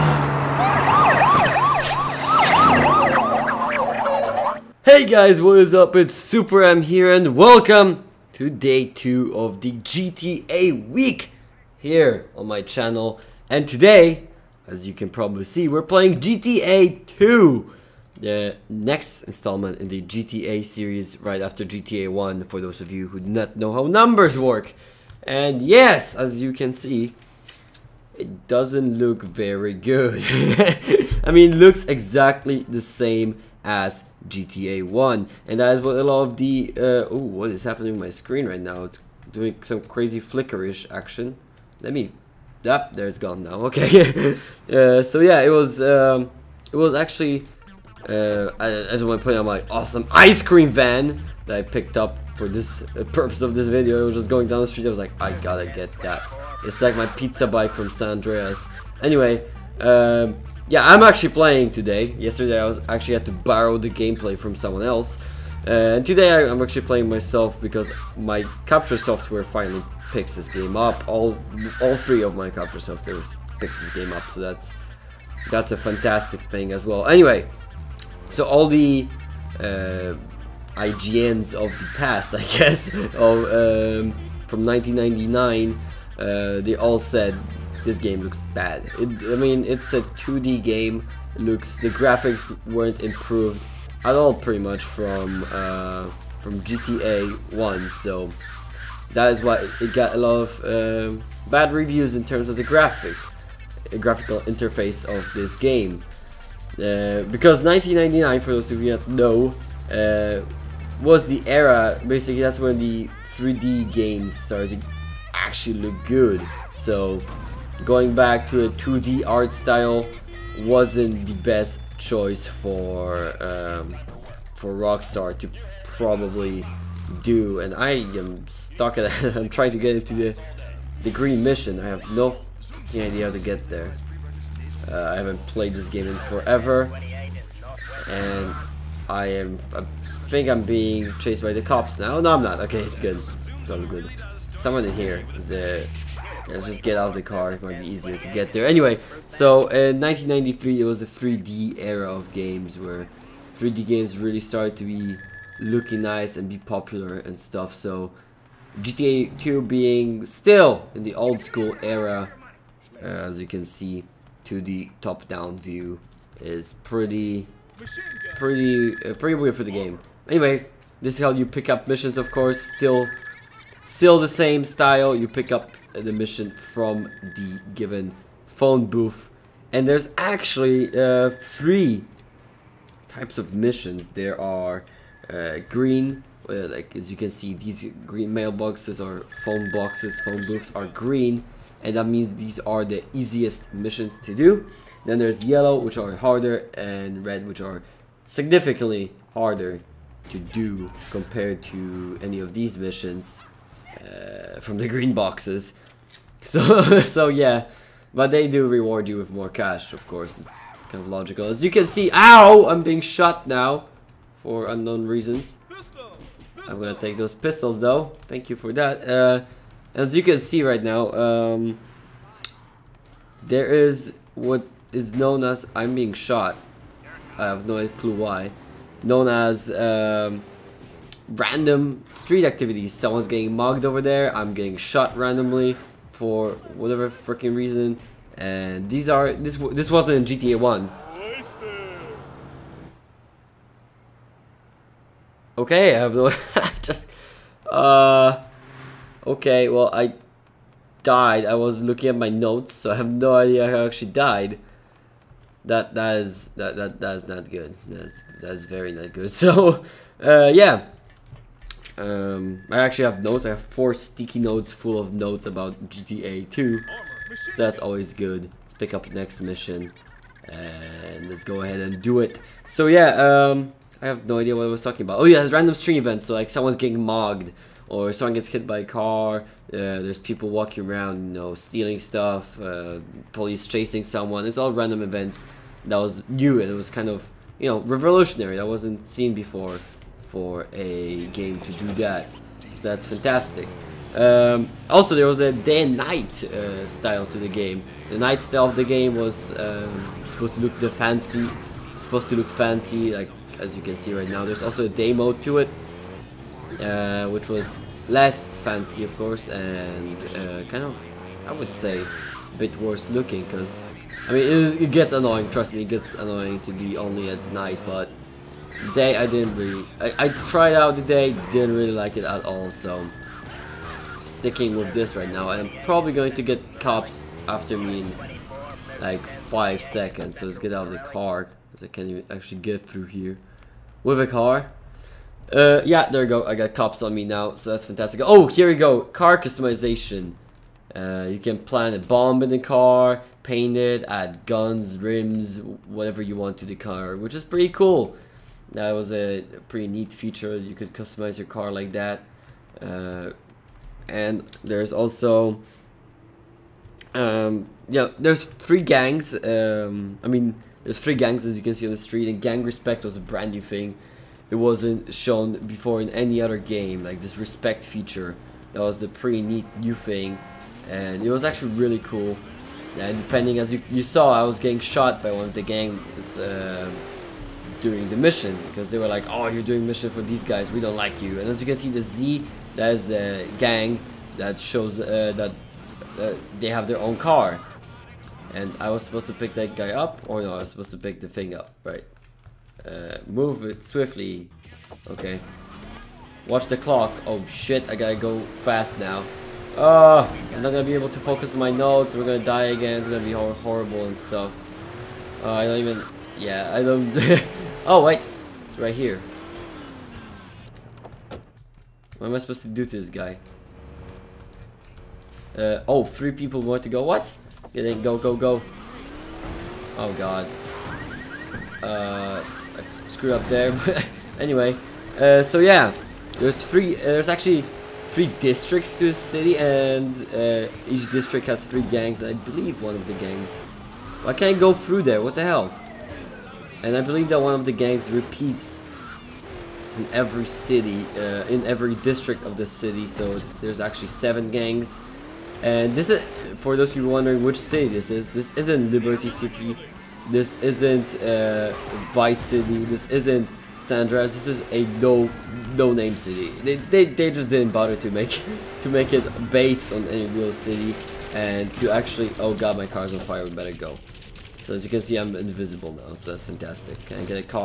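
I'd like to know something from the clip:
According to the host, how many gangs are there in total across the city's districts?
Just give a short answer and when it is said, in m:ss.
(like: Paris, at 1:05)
7, at 7:24.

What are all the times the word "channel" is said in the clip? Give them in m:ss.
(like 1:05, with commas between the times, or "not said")
0:12.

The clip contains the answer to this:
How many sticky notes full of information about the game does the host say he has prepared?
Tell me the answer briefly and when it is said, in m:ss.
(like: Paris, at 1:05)
4, at 4:23.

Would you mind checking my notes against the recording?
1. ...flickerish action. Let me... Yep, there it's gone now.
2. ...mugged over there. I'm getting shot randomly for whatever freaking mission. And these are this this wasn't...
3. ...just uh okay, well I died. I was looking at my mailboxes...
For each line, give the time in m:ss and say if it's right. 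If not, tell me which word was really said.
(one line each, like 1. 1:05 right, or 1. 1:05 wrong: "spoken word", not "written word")
1. 0:40 right
2. 3:53 wrong: "reason", not "mission"
3. 4:06 wrong: "notes", not "mailboxes".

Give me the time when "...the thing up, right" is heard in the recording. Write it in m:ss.
6:31.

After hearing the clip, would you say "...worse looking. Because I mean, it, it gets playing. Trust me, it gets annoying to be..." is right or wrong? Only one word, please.
wrong.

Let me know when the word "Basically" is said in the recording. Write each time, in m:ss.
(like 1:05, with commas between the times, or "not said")
1:52.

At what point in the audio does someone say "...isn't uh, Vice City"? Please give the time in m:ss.
7:30.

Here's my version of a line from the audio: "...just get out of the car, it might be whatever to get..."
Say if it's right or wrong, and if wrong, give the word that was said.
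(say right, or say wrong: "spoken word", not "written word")
wrong: "easier", not "whatever".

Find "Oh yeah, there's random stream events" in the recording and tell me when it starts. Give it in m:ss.
4:35.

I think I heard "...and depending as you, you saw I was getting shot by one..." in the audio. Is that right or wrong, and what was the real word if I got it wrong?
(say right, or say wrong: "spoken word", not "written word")
right.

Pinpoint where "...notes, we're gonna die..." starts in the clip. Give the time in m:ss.
6:41.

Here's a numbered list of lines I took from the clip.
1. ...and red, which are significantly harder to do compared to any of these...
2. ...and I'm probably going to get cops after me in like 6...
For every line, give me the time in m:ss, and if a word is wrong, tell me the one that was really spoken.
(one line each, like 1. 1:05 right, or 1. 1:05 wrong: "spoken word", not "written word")
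1. 3:16 right
2. 5:25 wrong: "5", not "6".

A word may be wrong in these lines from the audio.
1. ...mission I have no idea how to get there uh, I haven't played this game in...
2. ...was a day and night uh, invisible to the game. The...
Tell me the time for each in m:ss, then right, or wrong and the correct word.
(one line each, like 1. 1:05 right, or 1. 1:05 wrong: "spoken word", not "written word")
1. 2:11 right
2. 4:55 wrong: "style", not "invisible".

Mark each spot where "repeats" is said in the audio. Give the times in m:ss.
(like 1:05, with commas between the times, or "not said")
7:18.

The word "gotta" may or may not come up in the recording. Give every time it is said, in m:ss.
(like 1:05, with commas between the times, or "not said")
0:55, 6:37.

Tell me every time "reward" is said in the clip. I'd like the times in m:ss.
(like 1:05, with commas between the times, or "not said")
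3:28.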